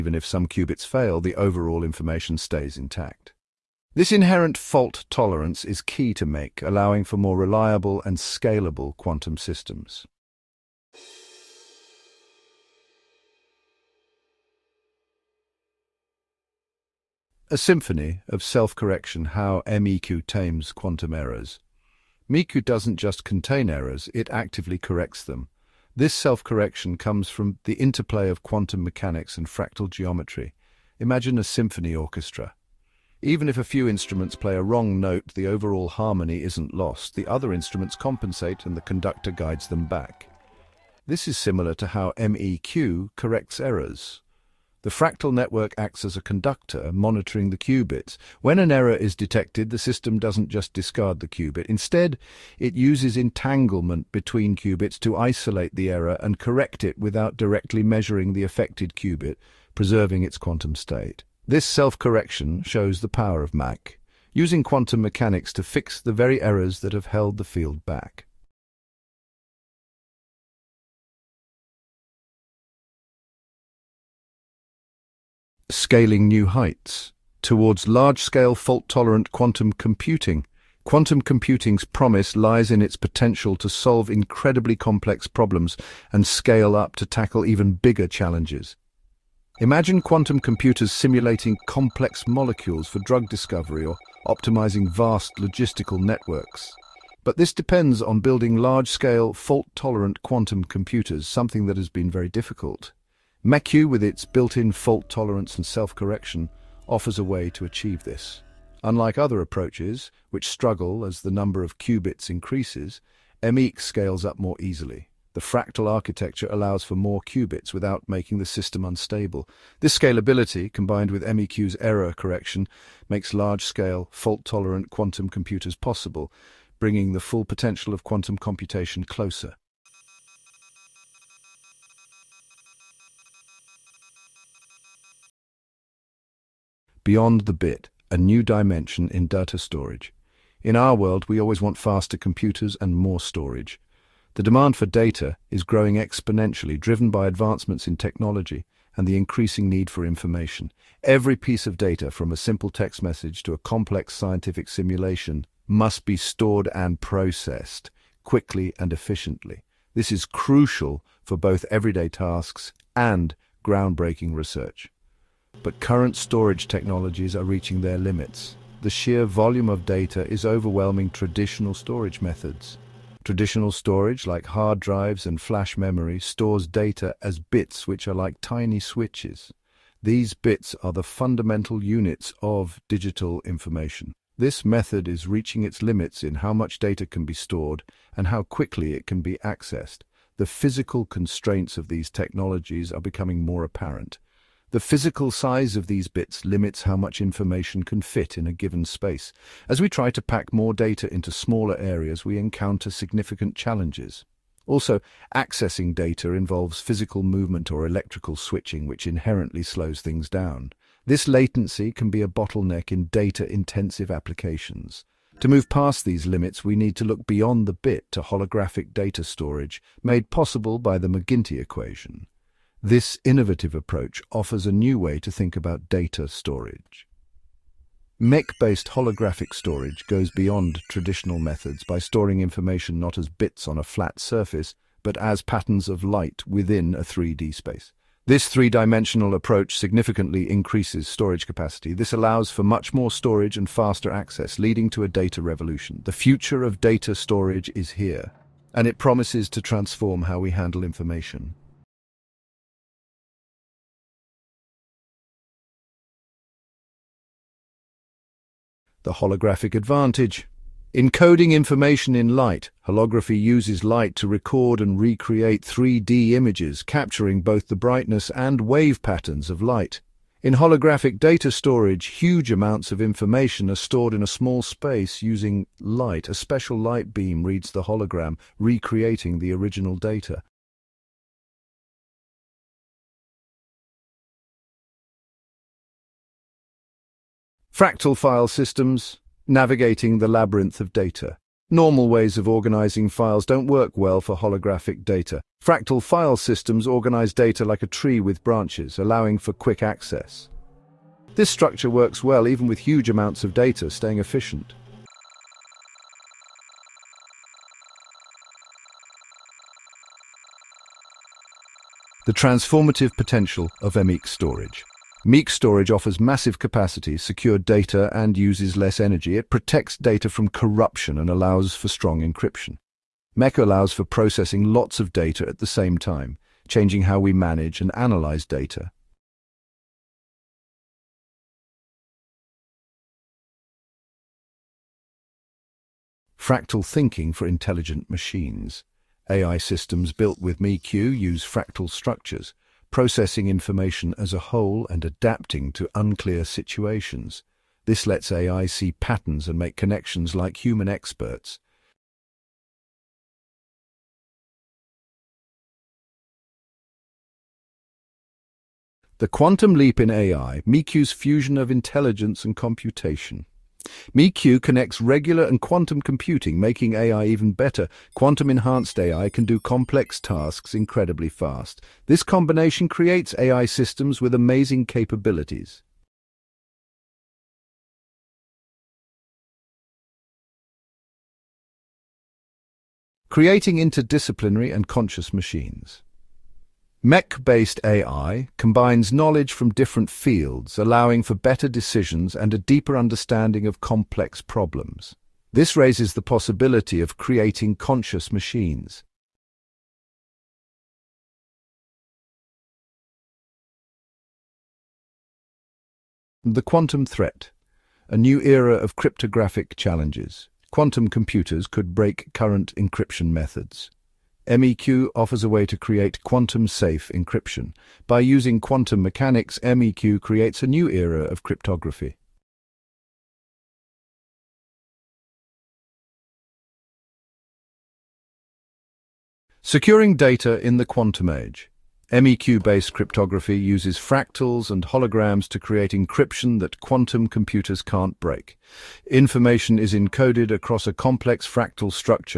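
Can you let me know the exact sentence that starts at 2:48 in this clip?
The sheer volume of data is overwhelming traditional storage methods.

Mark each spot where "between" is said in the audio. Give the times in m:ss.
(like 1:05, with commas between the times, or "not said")
0:54.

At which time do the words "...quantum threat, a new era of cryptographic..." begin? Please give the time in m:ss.
6:46.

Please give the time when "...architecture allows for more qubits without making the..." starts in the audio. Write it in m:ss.
1:55.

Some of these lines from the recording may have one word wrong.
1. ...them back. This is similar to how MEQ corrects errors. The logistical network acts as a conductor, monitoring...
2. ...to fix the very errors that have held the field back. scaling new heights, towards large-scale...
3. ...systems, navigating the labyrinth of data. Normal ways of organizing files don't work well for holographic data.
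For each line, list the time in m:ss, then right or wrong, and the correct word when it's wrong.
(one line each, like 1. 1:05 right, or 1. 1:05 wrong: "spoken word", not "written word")
1. 0:39 wrong: "fractal", not "logistical"
2. 1:05 right
3. 4:48 right.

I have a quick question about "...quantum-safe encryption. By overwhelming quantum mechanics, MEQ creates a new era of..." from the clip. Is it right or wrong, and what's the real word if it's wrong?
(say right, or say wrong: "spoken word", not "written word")
wrong: "using", not "overwhelming".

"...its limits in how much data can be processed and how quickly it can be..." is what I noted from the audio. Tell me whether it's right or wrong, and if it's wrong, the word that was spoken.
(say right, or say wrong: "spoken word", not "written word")
wrong: "stored", not "processed".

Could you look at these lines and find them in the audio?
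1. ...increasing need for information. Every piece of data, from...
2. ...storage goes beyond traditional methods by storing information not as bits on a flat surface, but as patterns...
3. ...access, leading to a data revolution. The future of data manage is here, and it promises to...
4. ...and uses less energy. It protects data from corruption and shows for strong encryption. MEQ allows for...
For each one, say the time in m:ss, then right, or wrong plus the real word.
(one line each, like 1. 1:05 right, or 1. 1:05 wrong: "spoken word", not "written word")
1. 2:29 right
2. 3:49 right
3. 4:04 wrong: "storage", not "manage"
4. 5:18 wrong: "allows", not "shows".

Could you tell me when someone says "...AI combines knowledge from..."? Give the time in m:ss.
6:27.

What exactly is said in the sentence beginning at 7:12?
MEQ-based cryptography uses fractals and holograms to create encryption that quantum computers can't break.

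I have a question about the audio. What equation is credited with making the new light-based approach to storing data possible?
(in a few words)
McGinty equation.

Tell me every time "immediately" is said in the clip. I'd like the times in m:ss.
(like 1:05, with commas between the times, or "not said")
not said.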